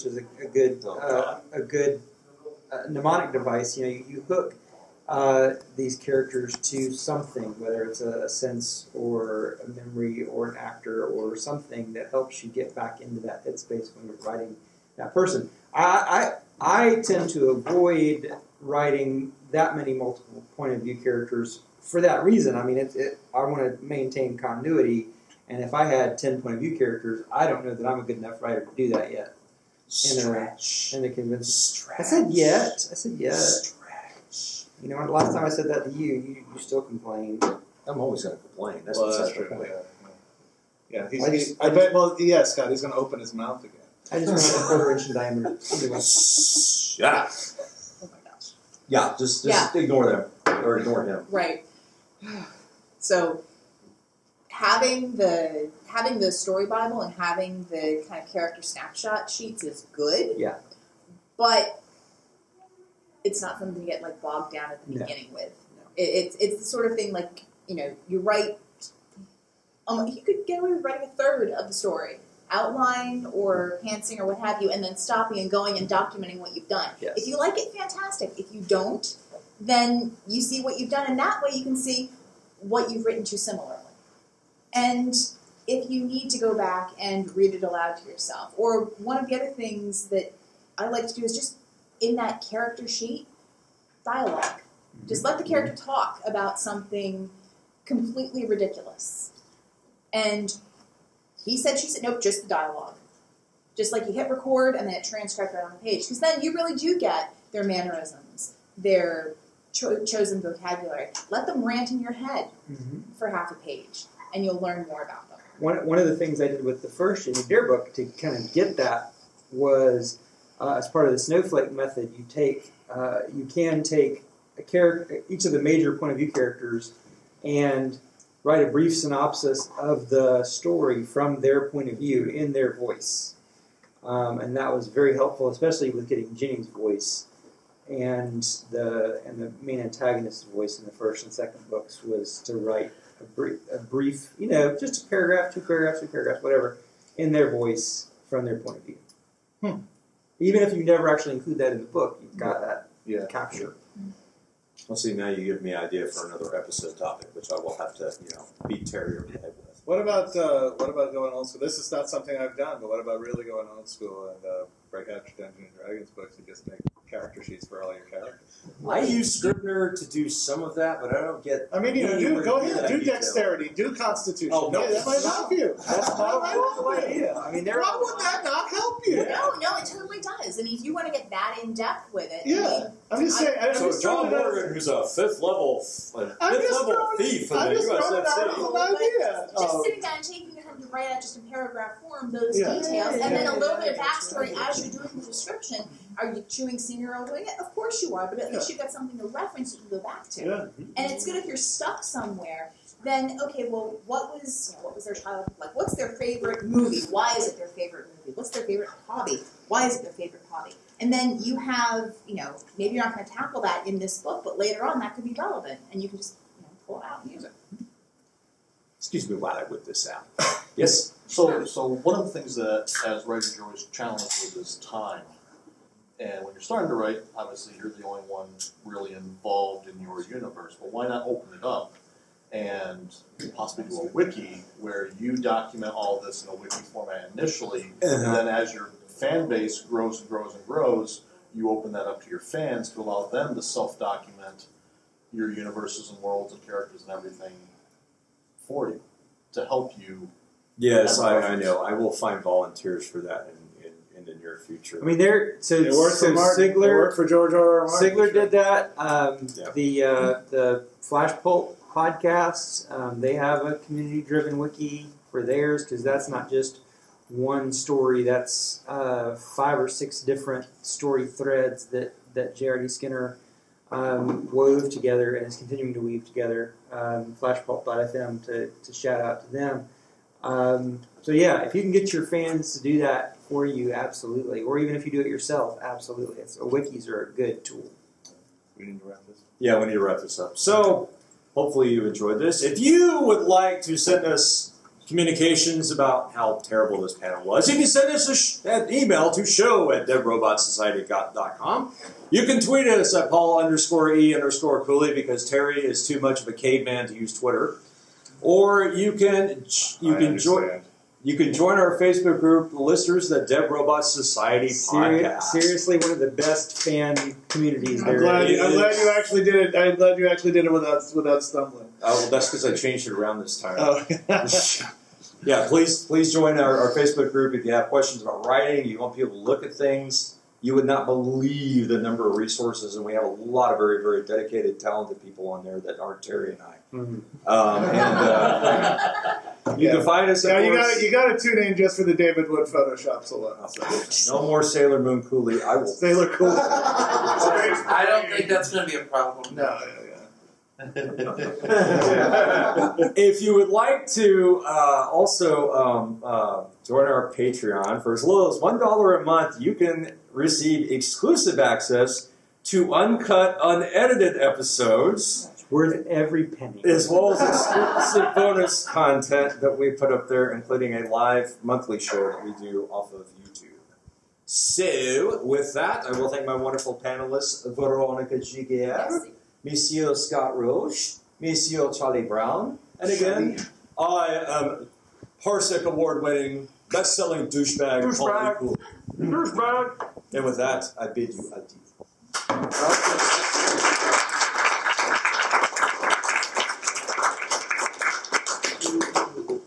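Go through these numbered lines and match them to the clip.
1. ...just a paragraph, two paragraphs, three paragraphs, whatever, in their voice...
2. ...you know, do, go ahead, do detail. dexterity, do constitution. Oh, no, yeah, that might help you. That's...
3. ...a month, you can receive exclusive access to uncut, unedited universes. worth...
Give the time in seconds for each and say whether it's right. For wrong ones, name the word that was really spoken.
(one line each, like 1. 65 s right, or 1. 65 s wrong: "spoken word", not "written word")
1. 144 s right
2. 171 s right
3. 359 s wrong: "episodes", not "universes".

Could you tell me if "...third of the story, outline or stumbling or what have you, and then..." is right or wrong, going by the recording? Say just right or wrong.
wrong.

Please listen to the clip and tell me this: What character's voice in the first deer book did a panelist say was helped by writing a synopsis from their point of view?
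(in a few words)
Ginny.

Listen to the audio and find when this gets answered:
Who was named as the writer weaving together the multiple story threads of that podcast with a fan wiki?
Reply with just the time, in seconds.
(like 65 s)
272 s.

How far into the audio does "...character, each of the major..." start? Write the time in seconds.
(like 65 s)
124 s.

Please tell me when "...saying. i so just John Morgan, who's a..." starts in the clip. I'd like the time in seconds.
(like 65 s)
183 s.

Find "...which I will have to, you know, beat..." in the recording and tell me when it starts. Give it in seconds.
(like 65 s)
157 s.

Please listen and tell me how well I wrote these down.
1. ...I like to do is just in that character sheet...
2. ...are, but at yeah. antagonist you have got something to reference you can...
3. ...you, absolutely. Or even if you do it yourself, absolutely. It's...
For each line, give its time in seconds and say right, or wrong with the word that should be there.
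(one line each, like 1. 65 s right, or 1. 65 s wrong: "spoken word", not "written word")
1. 90 s right
2. 198 s wrong: "least", not "antagonist"
3. 283 s right.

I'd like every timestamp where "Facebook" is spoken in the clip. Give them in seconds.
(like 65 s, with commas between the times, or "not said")
311 s, 326 s.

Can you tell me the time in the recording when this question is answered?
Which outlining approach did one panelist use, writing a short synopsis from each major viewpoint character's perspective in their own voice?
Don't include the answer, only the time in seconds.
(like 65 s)
121 s.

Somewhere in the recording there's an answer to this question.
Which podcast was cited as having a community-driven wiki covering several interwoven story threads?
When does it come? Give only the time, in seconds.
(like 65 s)
261 s.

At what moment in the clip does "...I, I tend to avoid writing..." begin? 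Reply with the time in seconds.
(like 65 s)
15 s.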